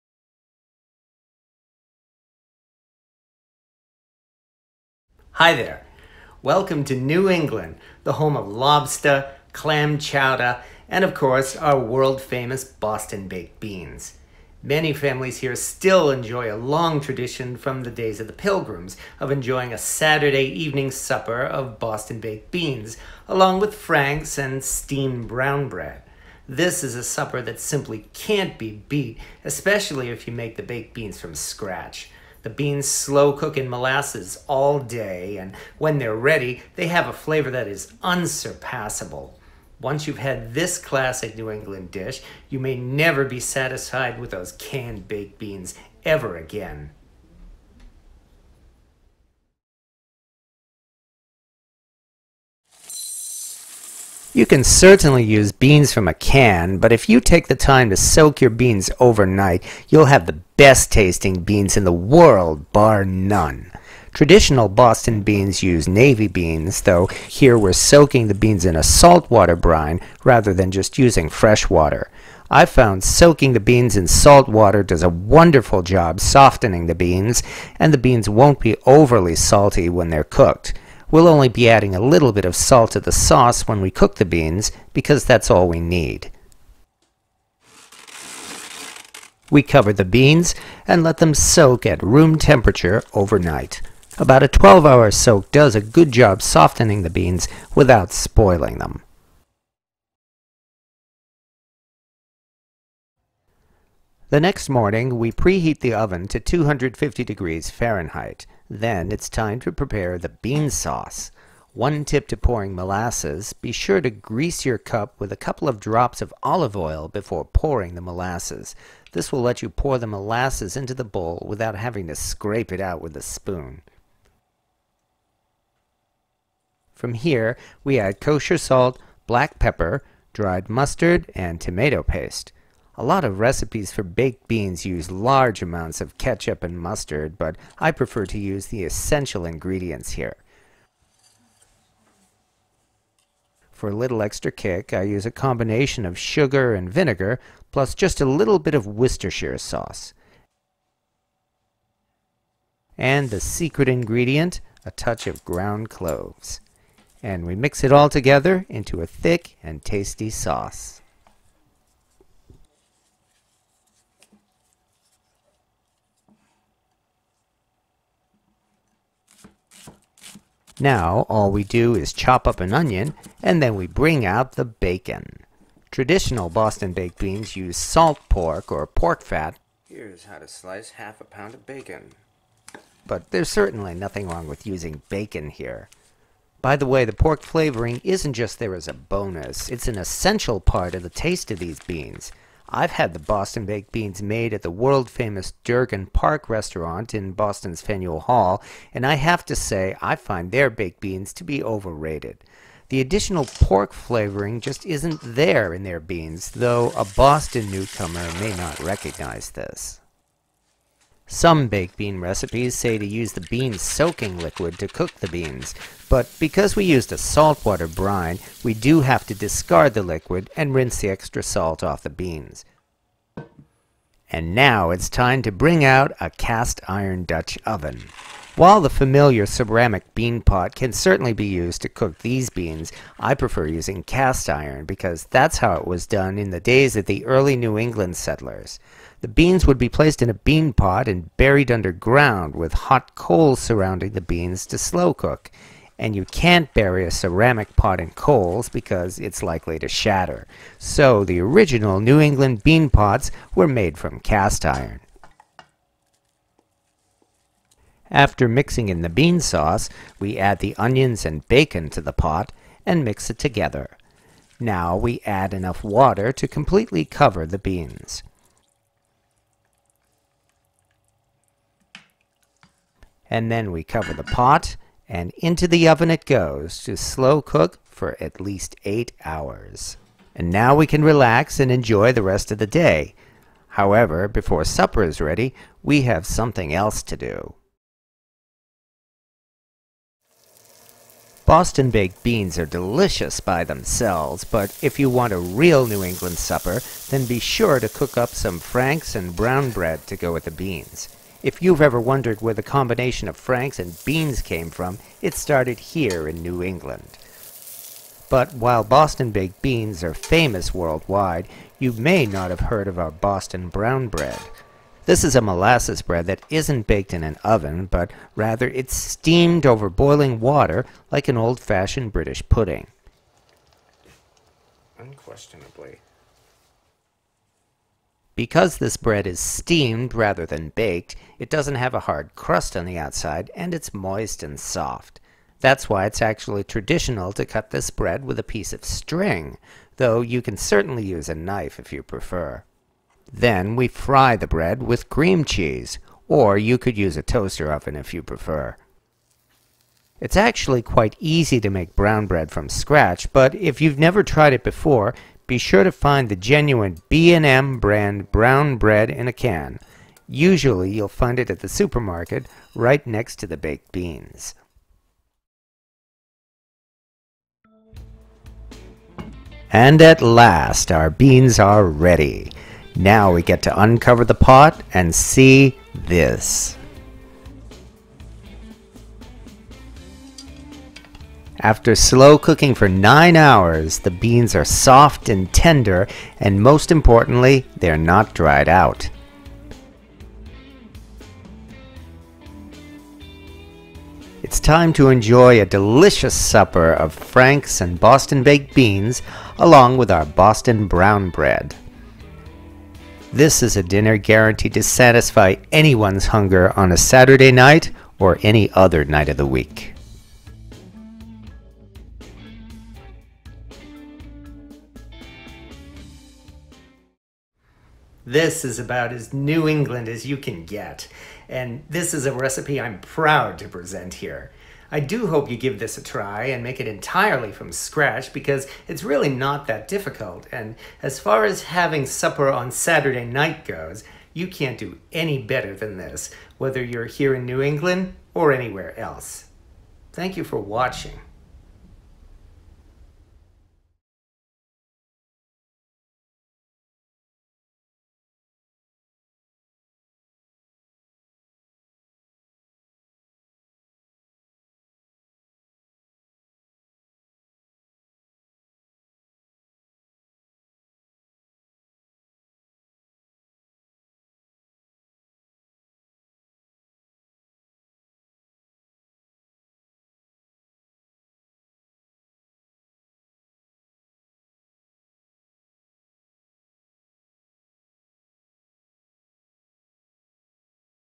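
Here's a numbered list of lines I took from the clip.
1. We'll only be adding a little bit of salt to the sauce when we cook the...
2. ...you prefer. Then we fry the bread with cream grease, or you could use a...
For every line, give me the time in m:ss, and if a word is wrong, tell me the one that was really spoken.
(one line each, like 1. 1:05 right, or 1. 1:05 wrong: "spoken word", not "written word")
1. 1:21 right
2. 5:41 wrong: "cheese", not "grease".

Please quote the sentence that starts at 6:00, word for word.
Usually you'll find it at the supermarket right next to the baked beans.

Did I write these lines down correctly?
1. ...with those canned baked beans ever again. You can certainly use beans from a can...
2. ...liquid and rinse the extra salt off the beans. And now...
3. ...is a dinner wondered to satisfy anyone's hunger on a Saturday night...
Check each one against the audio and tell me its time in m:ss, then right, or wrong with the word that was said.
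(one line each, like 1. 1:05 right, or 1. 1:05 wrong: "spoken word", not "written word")
1. 0:44 right
2. 3:40 right
3. 6:43 wrong: "guaranteed", not "wondered".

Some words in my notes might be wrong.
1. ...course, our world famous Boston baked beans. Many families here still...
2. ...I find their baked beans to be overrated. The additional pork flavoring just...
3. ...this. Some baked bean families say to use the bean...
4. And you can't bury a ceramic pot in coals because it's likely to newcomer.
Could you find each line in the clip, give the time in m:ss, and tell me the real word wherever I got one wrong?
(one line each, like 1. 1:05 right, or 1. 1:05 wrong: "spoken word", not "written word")
1. 0:11 right
2. 3:20 right
3. 3:29 wrong: "recipes", not "families"
4. 4:05 wrong: "shatter", not "newcomer".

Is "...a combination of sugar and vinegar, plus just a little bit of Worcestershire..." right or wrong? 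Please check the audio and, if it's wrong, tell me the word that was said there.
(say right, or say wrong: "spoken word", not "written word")
right.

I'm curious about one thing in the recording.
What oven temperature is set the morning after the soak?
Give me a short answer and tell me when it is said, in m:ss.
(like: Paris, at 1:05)
250 degrees Fahrenheit, at 1:46.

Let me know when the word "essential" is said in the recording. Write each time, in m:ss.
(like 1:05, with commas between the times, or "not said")
2:18, 3:09.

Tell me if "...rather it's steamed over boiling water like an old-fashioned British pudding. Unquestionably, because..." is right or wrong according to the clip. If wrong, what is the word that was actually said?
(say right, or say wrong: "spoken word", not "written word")
right.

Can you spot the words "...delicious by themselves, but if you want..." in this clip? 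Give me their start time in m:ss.
4:52.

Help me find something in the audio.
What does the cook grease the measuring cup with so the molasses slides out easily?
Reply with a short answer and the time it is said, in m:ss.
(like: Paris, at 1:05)
olive oil, at 1:56.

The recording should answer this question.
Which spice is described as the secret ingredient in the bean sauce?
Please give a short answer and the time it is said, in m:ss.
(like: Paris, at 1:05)
ground cloves, at 2:35.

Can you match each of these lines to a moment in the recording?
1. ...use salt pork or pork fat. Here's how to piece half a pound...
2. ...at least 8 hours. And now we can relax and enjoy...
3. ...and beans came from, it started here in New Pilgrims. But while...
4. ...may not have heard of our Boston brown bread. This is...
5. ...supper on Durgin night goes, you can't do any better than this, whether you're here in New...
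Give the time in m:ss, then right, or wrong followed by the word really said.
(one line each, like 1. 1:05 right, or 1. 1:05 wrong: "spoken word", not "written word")
1. 2:57 wrong: "slice", not "piece"
2. 4:38 right
3. 5:03 wrong: "England", not "Pilgrims"
4. 5:11 right
5. 7:12 wrong: "Saturday", not "Durgin".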